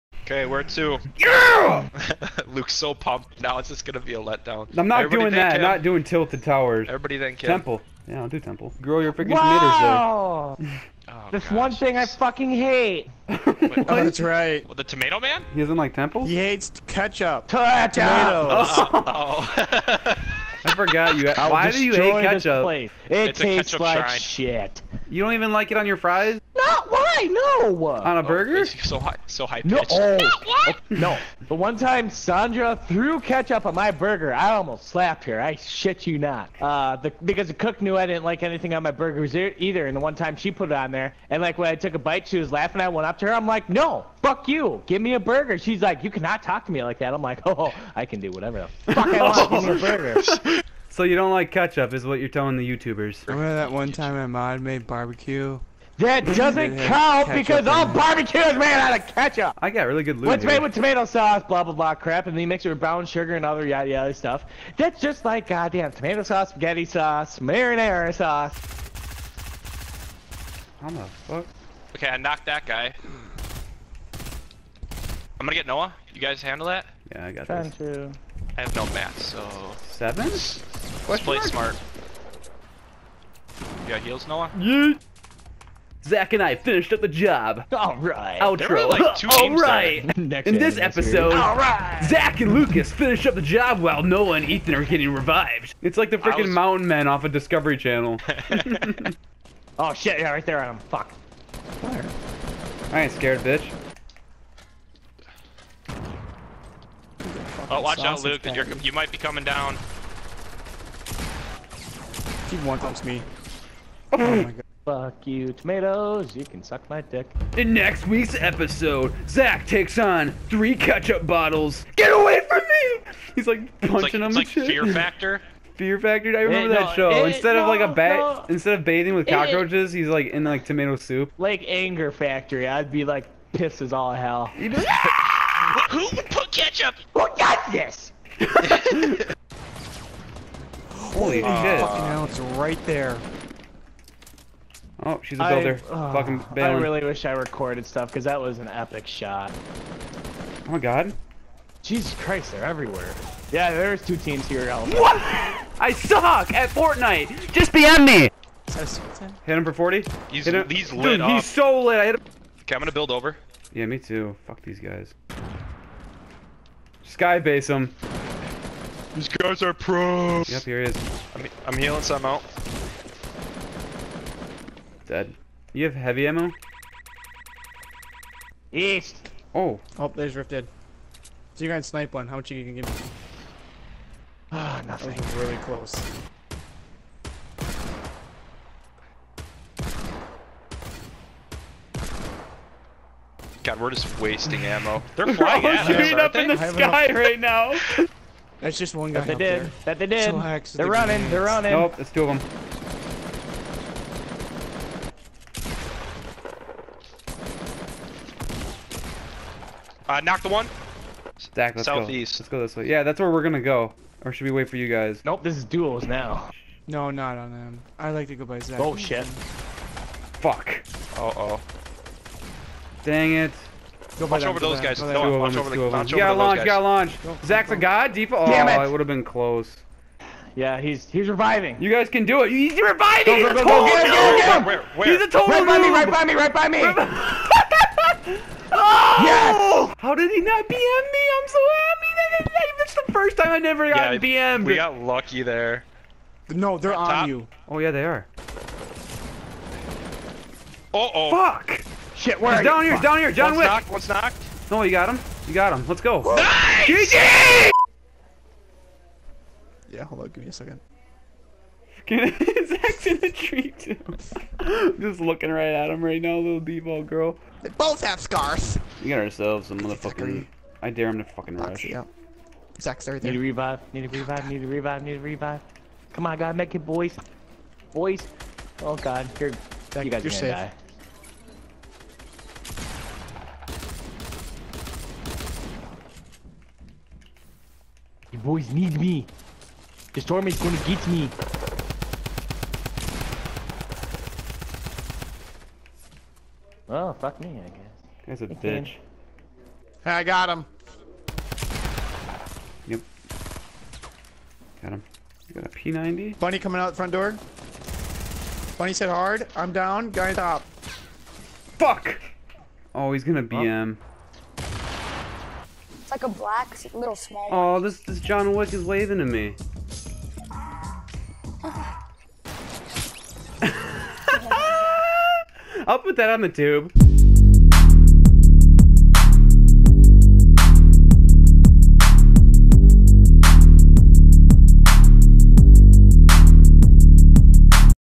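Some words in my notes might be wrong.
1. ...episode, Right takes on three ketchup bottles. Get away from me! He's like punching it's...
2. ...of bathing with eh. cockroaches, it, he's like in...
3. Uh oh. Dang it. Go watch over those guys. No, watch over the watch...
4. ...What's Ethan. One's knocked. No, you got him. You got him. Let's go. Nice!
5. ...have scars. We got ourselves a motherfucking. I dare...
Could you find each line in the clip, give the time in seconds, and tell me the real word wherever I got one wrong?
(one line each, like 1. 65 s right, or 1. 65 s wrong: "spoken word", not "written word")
1. 118 s wrong: "Zach", not "Right"
2. 128 s right
3. 221 s right
4. 253 s wrong: "Knocked", not "Ethan"
5. 268 s right.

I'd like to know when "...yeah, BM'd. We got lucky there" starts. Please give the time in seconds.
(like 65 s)
244 s.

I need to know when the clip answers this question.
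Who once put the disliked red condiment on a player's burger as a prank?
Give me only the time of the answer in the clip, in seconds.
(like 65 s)
32 s.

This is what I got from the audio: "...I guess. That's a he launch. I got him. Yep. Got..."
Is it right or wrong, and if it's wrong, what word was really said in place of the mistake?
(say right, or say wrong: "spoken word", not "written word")
wrong: "bitch", not "launch".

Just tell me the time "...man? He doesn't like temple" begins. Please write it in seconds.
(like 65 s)
15 s.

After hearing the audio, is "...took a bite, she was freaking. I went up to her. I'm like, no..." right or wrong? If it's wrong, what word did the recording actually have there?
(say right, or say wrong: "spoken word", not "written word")
wrong: "laughing", not "freaking".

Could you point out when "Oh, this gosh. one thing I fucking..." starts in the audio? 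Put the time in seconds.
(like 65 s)
11 s.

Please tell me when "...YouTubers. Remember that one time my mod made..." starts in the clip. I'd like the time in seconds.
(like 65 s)
52 s.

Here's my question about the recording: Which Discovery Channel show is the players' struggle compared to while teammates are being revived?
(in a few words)
Mountain Men.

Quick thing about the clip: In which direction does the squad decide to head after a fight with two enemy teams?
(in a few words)
Southeast.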